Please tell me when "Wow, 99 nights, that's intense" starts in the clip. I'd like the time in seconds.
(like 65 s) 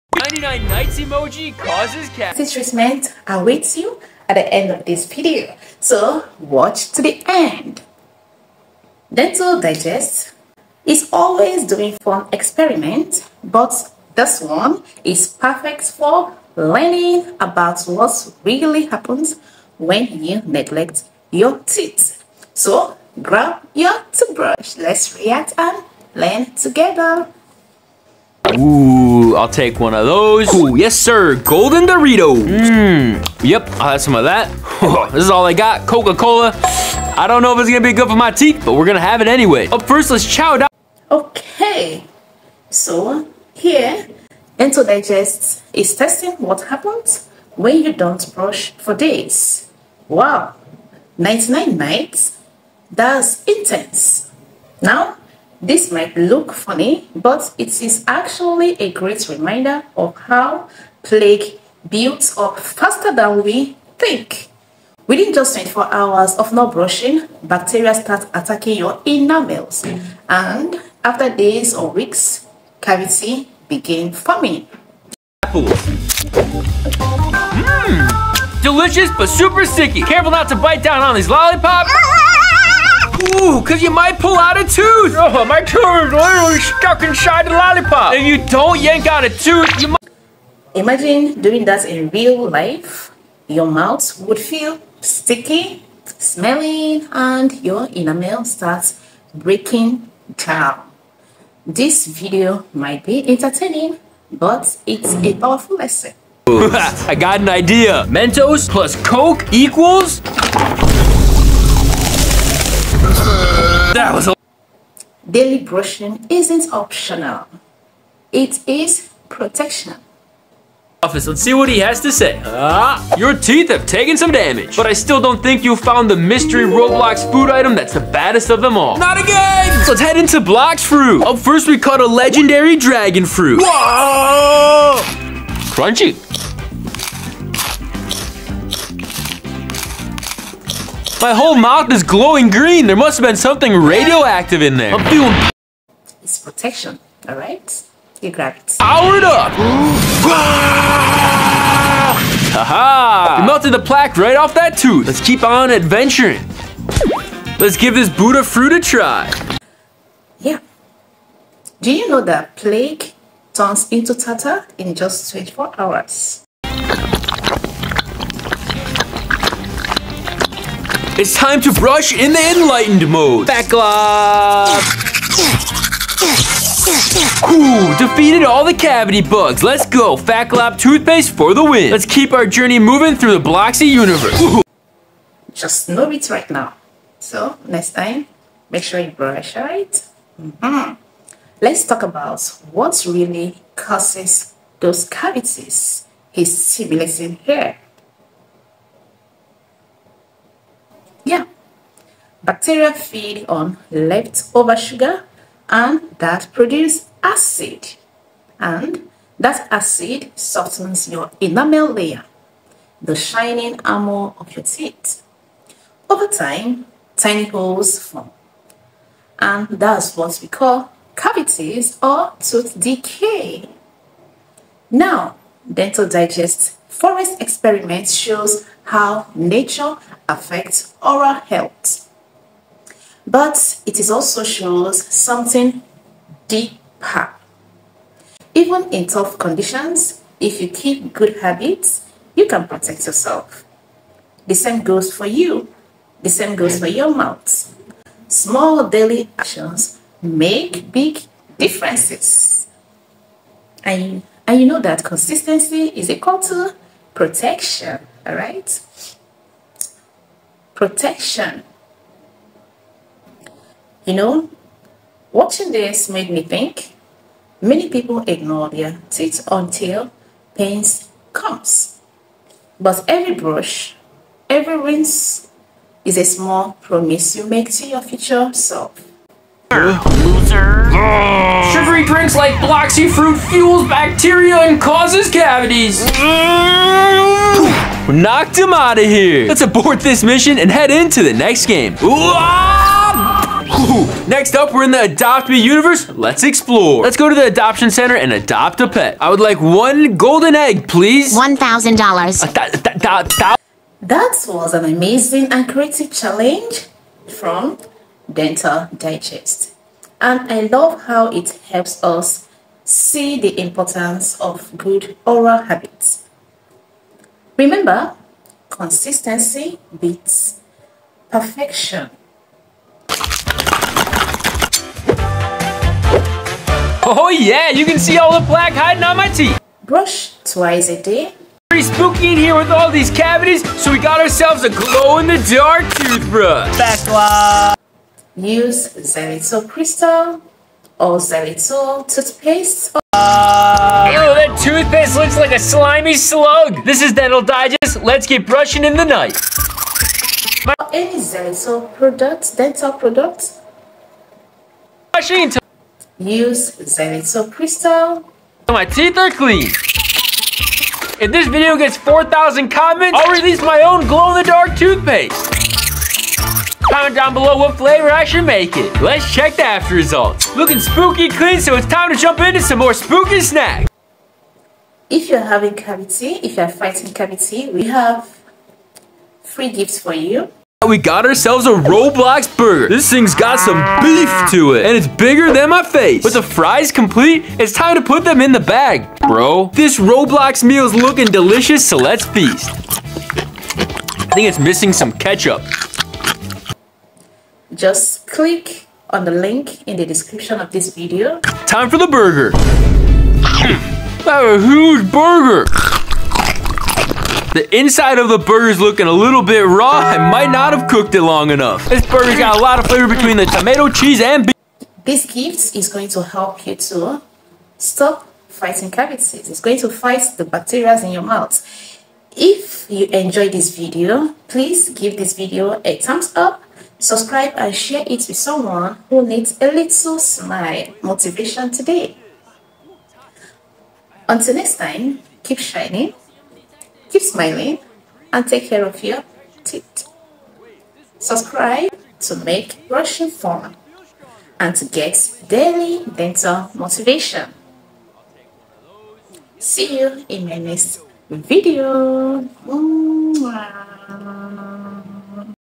50 s.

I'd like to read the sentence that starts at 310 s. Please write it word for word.
And I love how it helps us see the importance of good oral habits.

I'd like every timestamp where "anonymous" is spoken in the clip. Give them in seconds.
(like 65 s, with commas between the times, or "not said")
not said.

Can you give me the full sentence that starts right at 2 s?
This treatment awaits you at the end of this video.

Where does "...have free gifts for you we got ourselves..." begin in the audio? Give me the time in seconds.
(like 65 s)
377 s.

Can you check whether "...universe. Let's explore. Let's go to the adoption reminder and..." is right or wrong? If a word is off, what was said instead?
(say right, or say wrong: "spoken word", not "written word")
wrong: "center", not "reminder".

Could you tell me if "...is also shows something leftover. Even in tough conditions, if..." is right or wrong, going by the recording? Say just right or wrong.
wrong.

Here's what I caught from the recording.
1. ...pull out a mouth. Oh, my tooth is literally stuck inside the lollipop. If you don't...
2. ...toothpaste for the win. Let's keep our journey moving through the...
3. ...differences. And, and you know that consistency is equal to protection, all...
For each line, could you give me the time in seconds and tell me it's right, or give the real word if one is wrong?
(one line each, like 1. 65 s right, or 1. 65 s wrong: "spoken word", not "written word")
1. 84 s wrong: "tooth", not "mouth"
2. 180 s right
3. 251 s right.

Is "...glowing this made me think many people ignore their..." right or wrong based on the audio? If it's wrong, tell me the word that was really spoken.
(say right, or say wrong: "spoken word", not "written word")
wrong: "watching", not "glowing".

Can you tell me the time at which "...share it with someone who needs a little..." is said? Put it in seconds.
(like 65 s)
427 s.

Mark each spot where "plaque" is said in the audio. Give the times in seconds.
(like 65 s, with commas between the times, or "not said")
61 s, 153 s, 162 s, 328 s.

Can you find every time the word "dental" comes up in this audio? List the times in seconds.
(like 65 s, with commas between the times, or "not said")
9 s, 44 s, 225 s, 308 s, 347 s, 352 s, 446 s.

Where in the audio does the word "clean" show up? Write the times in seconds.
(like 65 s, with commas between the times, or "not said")
359 s, 371 s.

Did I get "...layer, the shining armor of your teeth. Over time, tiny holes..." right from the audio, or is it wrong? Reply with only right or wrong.
right.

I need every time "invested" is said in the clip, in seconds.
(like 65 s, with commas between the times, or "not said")
not said.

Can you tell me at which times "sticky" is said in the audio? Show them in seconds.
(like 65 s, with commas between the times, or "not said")
79 s, 95 s.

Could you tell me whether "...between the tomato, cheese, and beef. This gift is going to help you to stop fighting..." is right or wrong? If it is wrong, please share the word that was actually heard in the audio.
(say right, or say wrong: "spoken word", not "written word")
right.